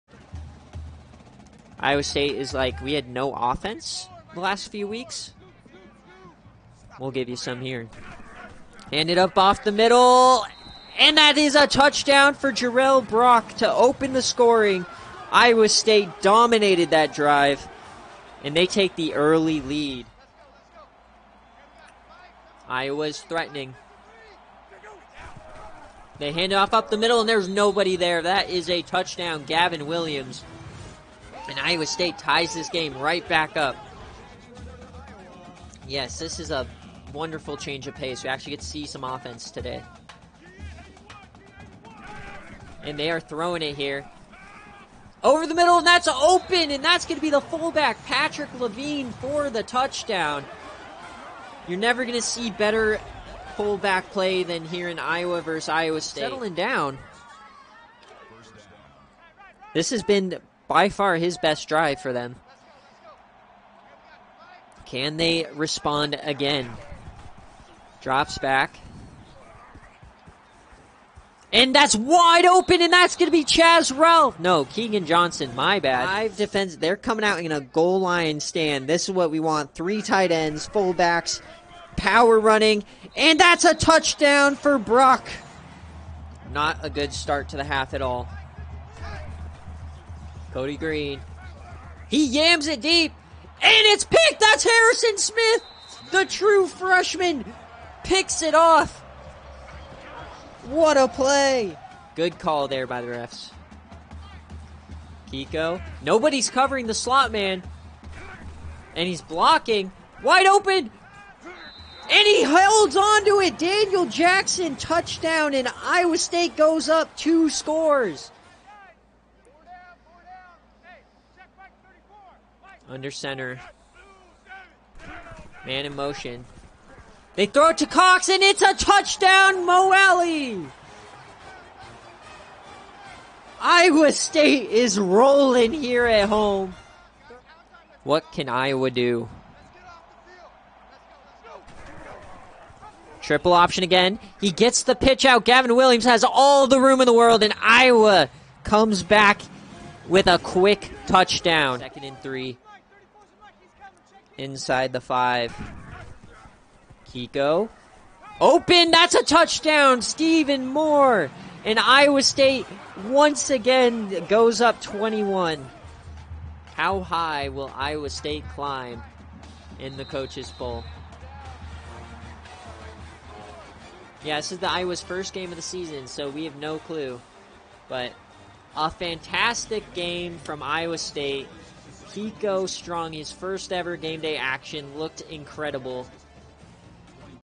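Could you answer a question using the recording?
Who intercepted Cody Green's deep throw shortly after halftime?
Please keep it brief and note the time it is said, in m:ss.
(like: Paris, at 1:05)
Harrison Smith, at 1:34.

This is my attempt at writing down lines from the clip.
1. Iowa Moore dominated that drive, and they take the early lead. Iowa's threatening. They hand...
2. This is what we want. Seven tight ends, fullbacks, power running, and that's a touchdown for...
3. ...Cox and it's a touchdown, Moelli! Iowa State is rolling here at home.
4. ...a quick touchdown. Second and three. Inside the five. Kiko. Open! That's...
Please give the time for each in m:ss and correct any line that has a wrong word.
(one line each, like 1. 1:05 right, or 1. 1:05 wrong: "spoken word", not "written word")
1. 0:15 wrong: "State", not "Moore"
2. 1:18 wrong: "Three", not "Seven"
3. 2:07 right
4. 2:30 right.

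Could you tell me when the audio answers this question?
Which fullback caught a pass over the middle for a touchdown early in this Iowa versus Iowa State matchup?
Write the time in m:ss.
0:48.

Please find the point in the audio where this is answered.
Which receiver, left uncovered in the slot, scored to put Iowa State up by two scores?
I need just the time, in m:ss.
1:53.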